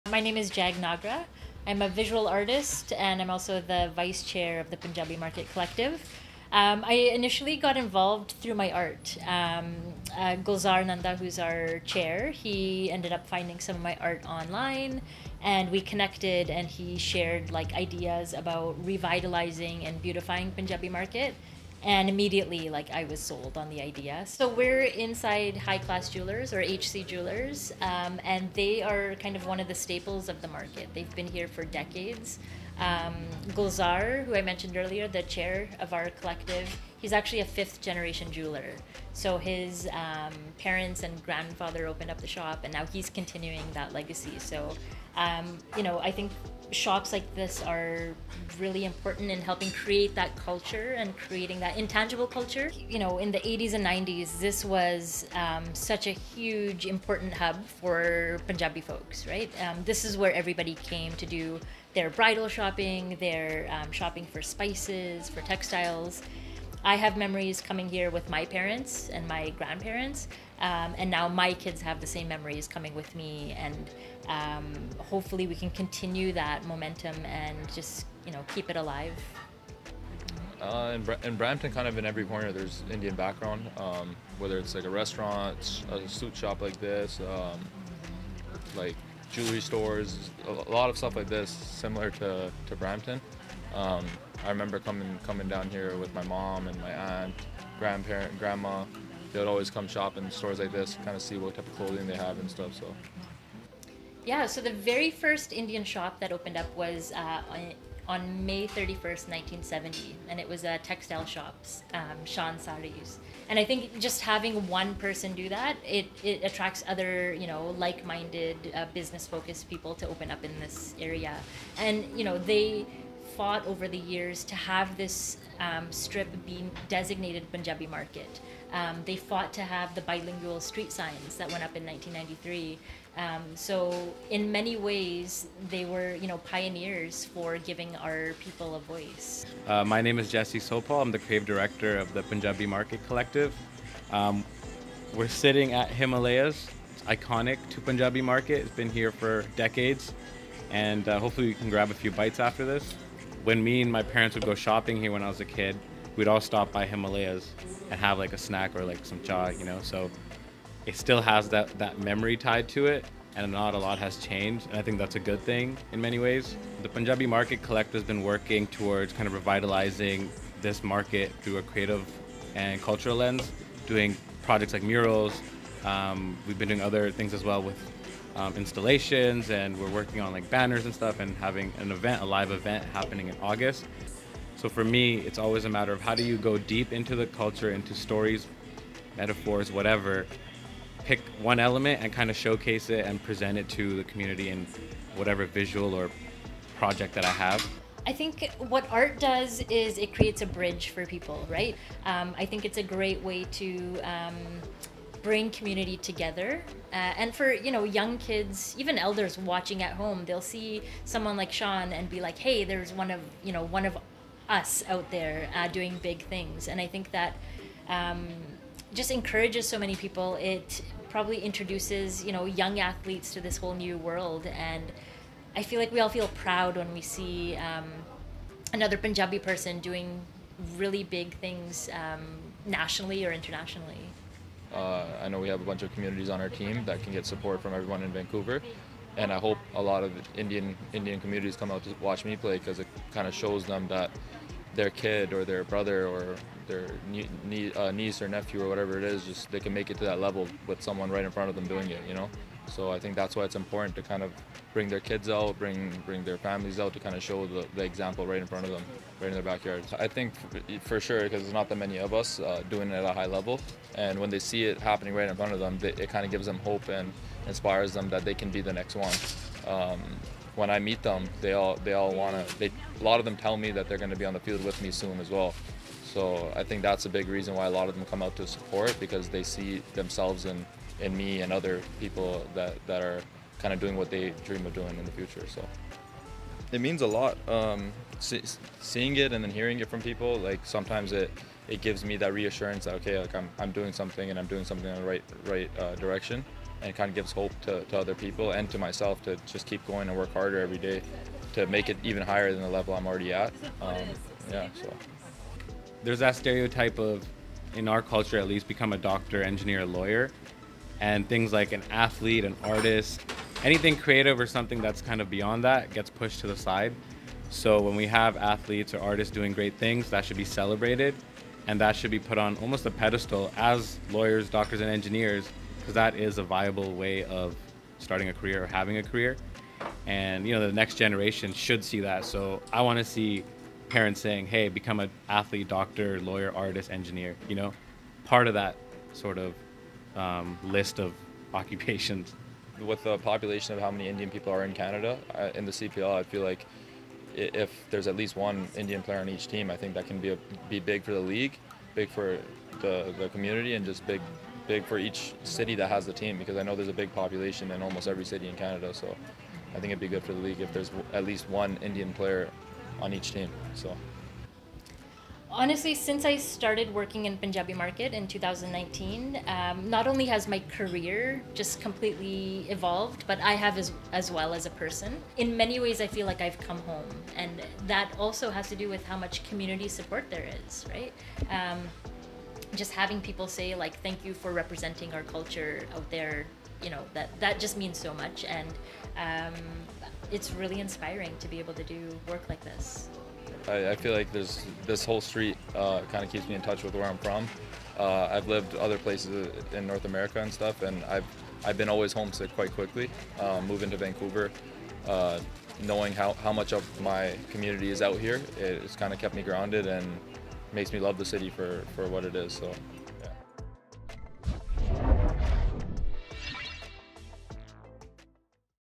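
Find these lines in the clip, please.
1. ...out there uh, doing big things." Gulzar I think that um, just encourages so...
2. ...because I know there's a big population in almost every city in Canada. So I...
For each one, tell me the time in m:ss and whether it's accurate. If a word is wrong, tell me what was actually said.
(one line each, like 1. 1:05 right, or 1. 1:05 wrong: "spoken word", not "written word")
1. 3:34 wrong: "And", not "Gulzar"
2. 5:56 right.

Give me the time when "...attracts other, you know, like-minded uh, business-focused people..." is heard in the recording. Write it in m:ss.
1:56.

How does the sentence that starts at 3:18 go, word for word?
I think what art does is it creates a bridge for people, right?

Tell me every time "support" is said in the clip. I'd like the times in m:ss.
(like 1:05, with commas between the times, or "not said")
3:57, 4:38, 6:19.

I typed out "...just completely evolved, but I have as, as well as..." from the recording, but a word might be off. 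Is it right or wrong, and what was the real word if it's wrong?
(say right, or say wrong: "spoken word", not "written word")
right.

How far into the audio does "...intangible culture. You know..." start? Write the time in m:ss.
0:51.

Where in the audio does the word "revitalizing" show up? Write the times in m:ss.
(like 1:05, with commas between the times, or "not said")
0:18, 2:49.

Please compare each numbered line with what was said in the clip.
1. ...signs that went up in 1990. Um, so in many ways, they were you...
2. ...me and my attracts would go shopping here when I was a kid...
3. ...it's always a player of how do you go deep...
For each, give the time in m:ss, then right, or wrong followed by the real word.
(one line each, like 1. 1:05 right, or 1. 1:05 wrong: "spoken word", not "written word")
1. 2:10 wrong: "1993", not "1990"
2. 2:33 wrong: "parents", not "attracts"
3. 3:05 wrong: "matter", not "player".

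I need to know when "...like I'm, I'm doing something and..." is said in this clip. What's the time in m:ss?
4:53.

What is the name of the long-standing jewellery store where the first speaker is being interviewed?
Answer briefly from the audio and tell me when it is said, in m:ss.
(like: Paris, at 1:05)
High Class Jewelers, at 0:25.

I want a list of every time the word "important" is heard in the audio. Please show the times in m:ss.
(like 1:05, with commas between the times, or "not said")
0:48, 0:56, 4:13.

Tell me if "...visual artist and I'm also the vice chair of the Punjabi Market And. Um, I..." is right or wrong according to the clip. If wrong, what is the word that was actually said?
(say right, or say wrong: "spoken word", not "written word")
wrong: "Collective", not "And".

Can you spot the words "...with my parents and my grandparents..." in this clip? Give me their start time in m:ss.
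1:08.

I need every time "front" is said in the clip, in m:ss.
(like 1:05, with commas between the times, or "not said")
4:11, 4:18, 4:25.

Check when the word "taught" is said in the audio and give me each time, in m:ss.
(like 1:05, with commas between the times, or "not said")
not said.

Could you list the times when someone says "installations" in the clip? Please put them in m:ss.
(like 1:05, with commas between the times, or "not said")
2:58.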